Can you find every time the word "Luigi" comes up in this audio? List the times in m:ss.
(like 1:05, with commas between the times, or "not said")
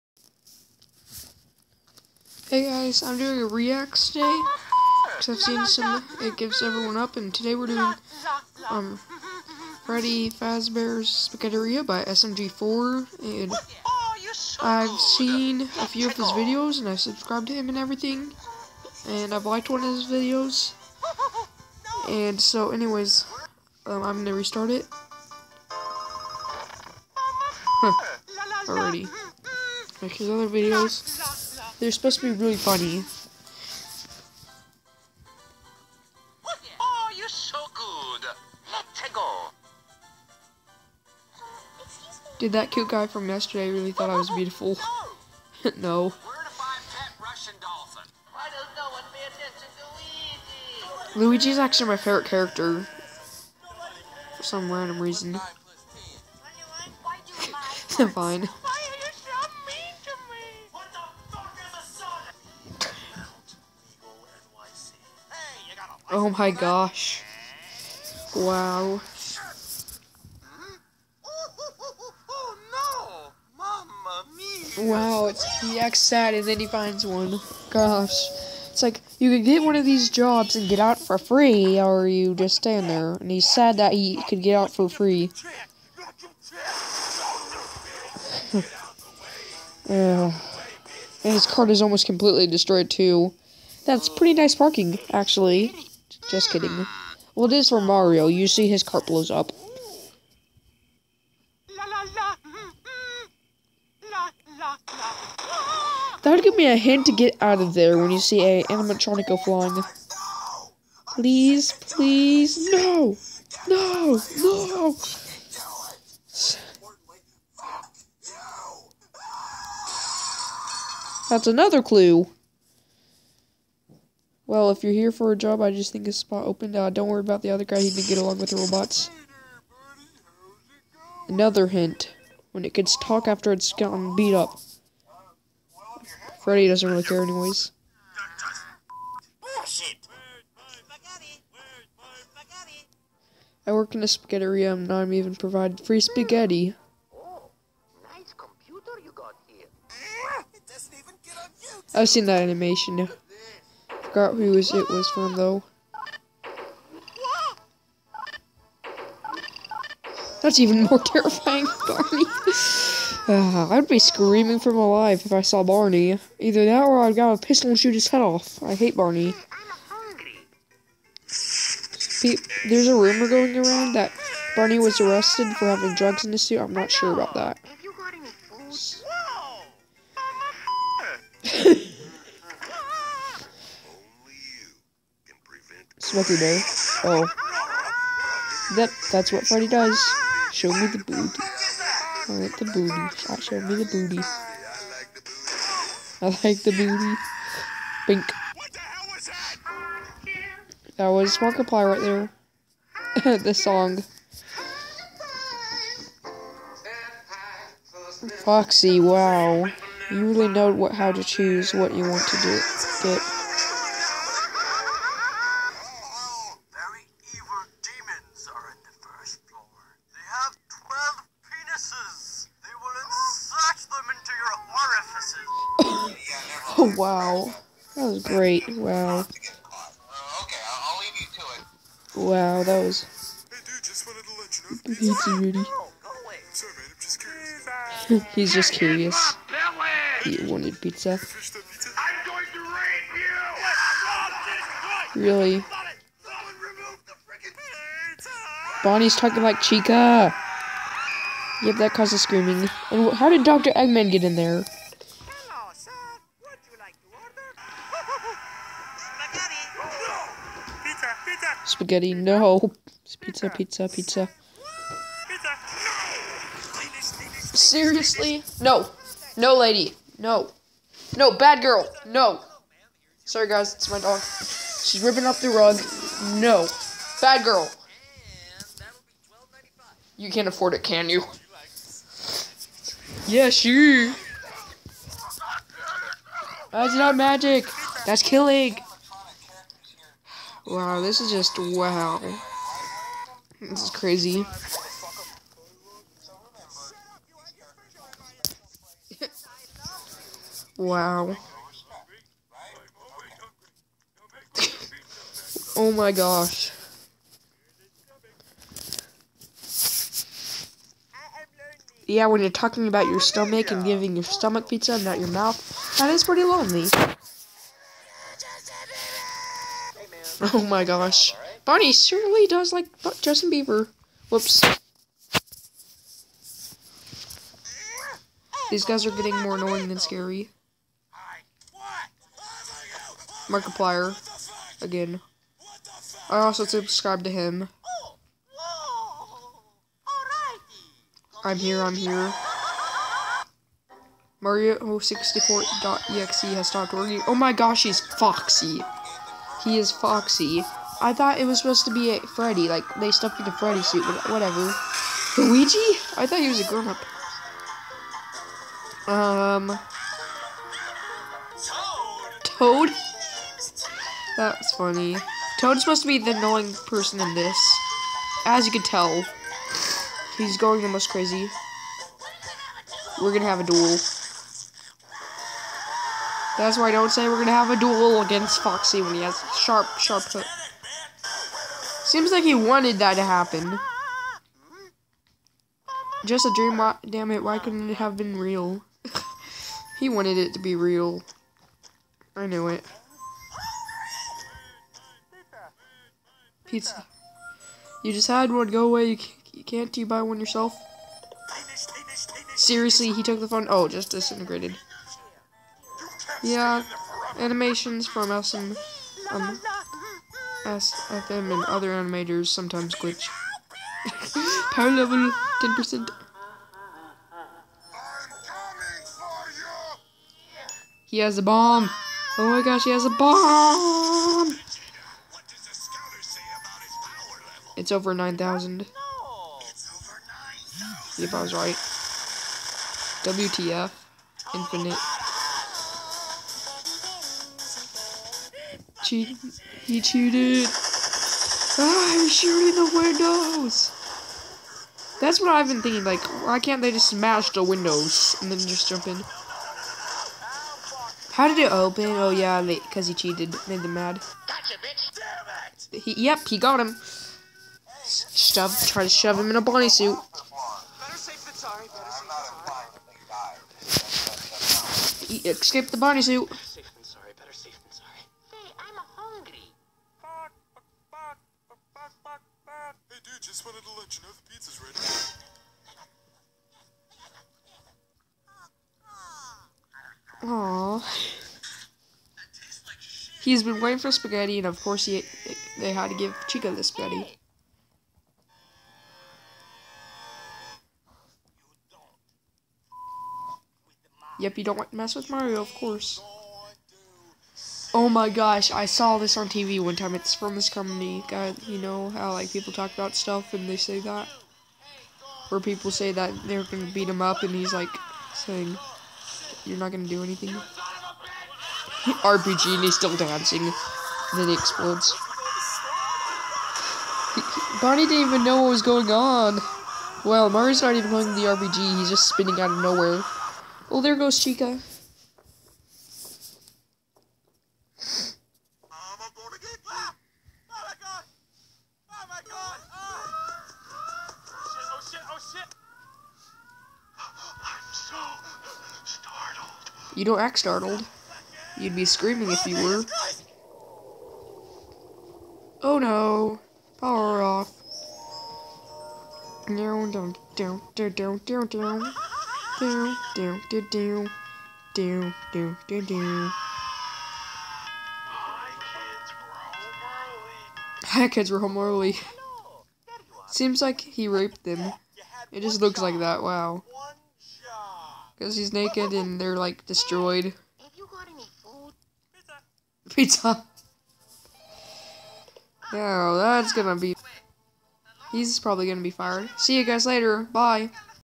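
0:51, 5:55.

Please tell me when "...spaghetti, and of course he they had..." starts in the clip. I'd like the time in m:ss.
8:04.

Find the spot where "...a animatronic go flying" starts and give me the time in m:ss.
1:48.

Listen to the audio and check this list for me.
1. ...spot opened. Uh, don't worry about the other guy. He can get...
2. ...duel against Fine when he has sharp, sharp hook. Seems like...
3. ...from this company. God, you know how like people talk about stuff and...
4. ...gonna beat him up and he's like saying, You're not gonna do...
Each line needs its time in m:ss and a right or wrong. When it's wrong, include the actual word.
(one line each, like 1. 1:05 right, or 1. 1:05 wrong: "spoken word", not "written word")
1. 2:06 right
2. 6:17 wrong: "Foxy", not "Fine"
3. 8:20 right
4. 8:26 right.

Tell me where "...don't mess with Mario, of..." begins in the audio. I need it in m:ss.
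8:14.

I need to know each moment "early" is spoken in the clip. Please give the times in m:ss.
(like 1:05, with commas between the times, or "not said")
9:21.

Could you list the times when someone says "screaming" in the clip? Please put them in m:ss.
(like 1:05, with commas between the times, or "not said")
2:43, 4:12, 9:02.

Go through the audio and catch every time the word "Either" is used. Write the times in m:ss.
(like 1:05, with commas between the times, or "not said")
2:46.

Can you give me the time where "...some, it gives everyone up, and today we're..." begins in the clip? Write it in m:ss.
0:05.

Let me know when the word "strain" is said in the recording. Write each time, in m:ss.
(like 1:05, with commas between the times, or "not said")
not said.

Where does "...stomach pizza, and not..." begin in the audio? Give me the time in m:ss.
5:14.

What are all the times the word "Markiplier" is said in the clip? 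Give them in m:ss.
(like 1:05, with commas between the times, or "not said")
3:21, 5:33.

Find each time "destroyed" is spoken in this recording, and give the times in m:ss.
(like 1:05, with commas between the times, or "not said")
1:32, 9:29.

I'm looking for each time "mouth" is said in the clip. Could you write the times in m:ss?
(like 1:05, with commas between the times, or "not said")
5:15.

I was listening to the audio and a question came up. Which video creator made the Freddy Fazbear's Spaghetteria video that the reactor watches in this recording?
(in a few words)
SMG4.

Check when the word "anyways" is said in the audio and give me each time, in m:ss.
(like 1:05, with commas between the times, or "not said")
0:22, 2:17.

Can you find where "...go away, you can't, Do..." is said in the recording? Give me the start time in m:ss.
6:38.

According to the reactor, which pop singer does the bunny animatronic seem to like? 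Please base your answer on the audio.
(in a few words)
Justin Bieber.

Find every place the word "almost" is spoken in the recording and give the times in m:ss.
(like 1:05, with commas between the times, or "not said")
1:31.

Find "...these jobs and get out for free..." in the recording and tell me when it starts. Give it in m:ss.
1:19.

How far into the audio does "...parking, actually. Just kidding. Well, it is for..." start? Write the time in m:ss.
1:34.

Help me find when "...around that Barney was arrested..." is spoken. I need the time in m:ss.
2:53.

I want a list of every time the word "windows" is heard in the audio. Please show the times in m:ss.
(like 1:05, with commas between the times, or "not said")
7:22, 7:27.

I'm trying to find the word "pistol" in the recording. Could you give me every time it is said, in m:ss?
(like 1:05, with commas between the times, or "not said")
2:47.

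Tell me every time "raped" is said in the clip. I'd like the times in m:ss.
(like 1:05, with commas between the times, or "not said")
9:24.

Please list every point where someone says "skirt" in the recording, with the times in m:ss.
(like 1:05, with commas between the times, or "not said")
not said.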